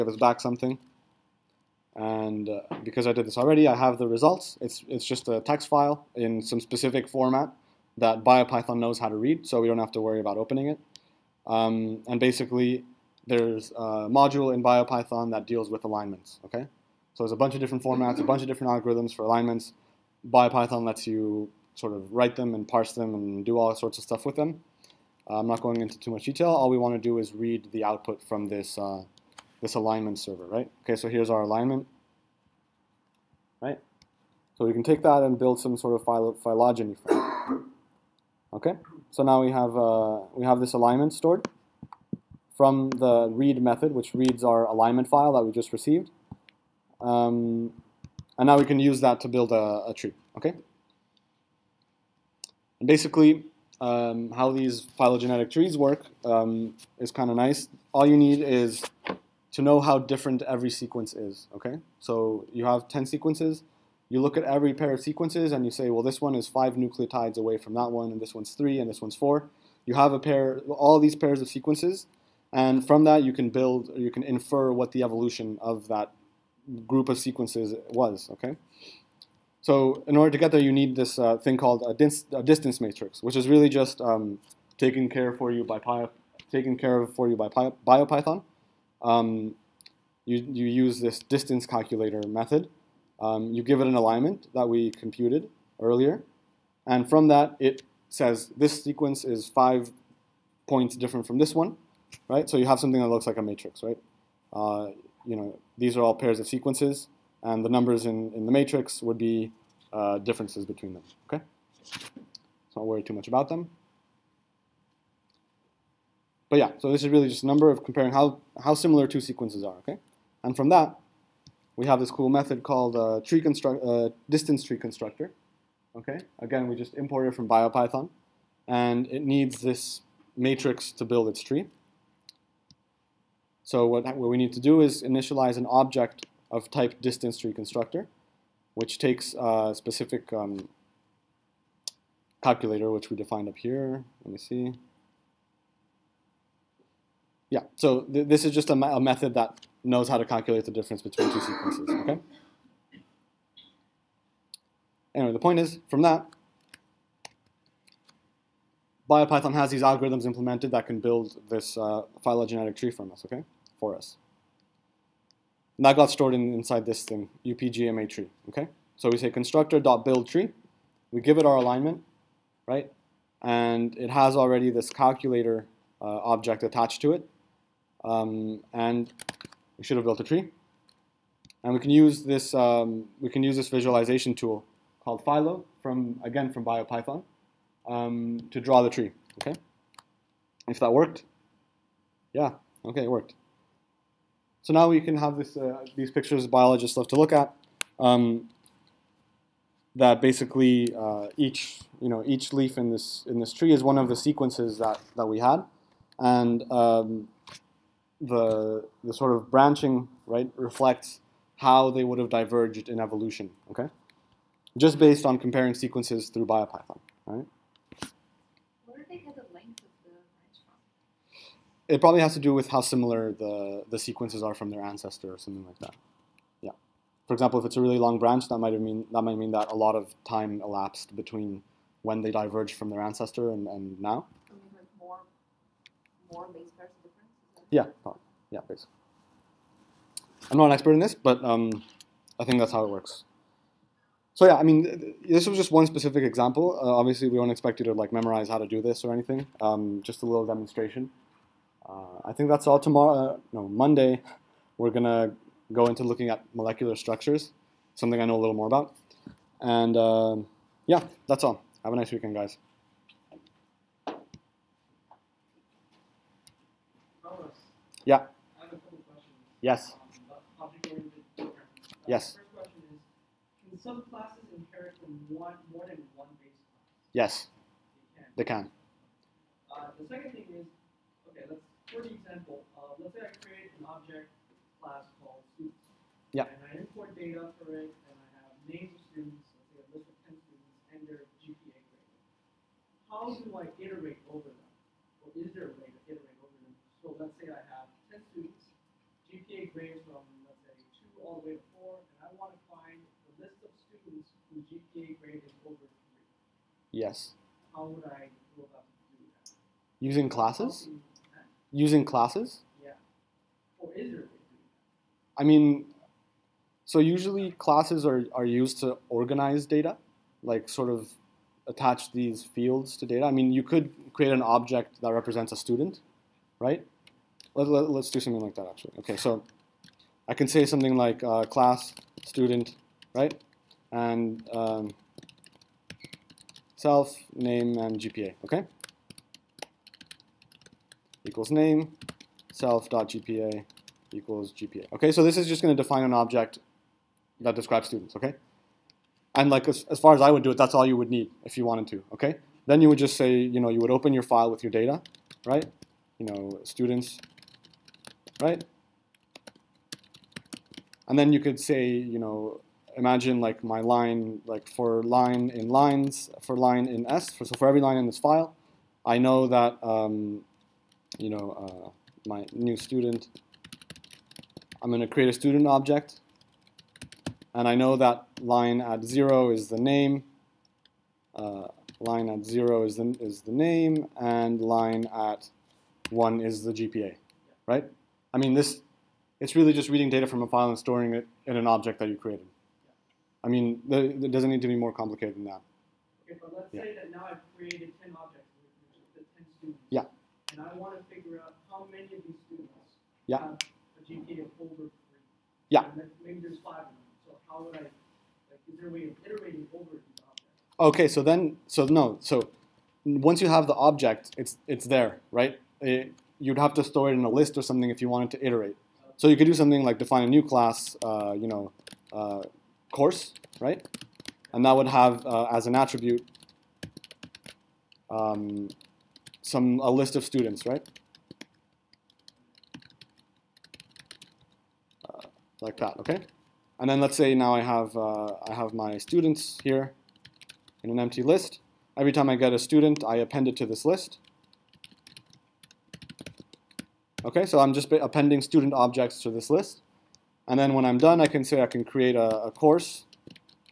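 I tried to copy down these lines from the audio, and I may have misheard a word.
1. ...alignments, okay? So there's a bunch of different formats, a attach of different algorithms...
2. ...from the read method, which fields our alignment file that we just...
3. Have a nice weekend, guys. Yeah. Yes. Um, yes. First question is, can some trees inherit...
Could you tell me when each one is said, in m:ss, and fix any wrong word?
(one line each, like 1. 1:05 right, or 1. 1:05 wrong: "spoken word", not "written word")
1. 0:15 wrong: "bunch", not "attach"
2. 0:42 wrong: "reads", not "fields"
3. 4:21 wrong: "classes", not "trees".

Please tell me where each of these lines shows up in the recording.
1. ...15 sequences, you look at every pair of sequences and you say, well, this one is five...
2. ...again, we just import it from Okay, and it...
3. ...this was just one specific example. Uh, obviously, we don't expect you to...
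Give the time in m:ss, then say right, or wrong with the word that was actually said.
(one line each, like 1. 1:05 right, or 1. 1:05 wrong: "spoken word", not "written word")
1. 1:02 wrong: "10", not "15"
2. 2:06 wrong: "BioPython", not "Okay"
3. 4:05 right.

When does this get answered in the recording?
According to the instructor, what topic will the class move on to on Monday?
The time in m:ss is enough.
4:16.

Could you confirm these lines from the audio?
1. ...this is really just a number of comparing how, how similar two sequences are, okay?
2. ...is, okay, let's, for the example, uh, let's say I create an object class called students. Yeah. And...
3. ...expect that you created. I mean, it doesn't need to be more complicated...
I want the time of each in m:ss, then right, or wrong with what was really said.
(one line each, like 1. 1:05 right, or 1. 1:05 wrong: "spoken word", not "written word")
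1. 1:56 right
2. 4:40 right
3. 6:31 wrong: "object", not "expect".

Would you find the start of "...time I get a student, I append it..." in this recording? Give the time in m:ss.
7:22.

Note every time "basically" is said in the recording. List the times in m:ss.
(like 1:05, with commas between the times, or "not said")
0:12, 0:52, 3:20, 3:58.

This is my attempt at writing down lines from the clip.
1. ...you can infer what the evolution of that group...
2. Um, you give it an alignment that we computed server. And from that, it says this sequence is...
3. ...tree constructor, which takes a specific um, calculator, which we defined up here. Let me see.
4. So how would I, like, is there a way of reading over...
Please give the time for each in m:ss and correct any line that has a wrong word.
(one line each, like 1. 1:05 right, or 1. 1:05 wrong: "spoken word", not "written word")
1. 1:13 right
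2. 1:33 wrong: "earlier", not "server"
3. 2:17 right
4. 6:47 wrong: "iterating", not "reading".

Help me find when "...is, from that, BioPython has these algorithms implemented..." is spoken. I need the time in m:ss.
2:35.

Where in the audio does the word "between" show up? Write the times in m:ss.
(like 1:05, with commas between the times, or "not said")
1:50, 2:31, 3:51.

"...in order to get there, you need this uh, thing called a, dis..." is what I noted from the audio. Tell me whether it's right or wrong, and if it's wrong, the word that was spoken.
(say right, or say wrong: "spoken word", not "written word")
right.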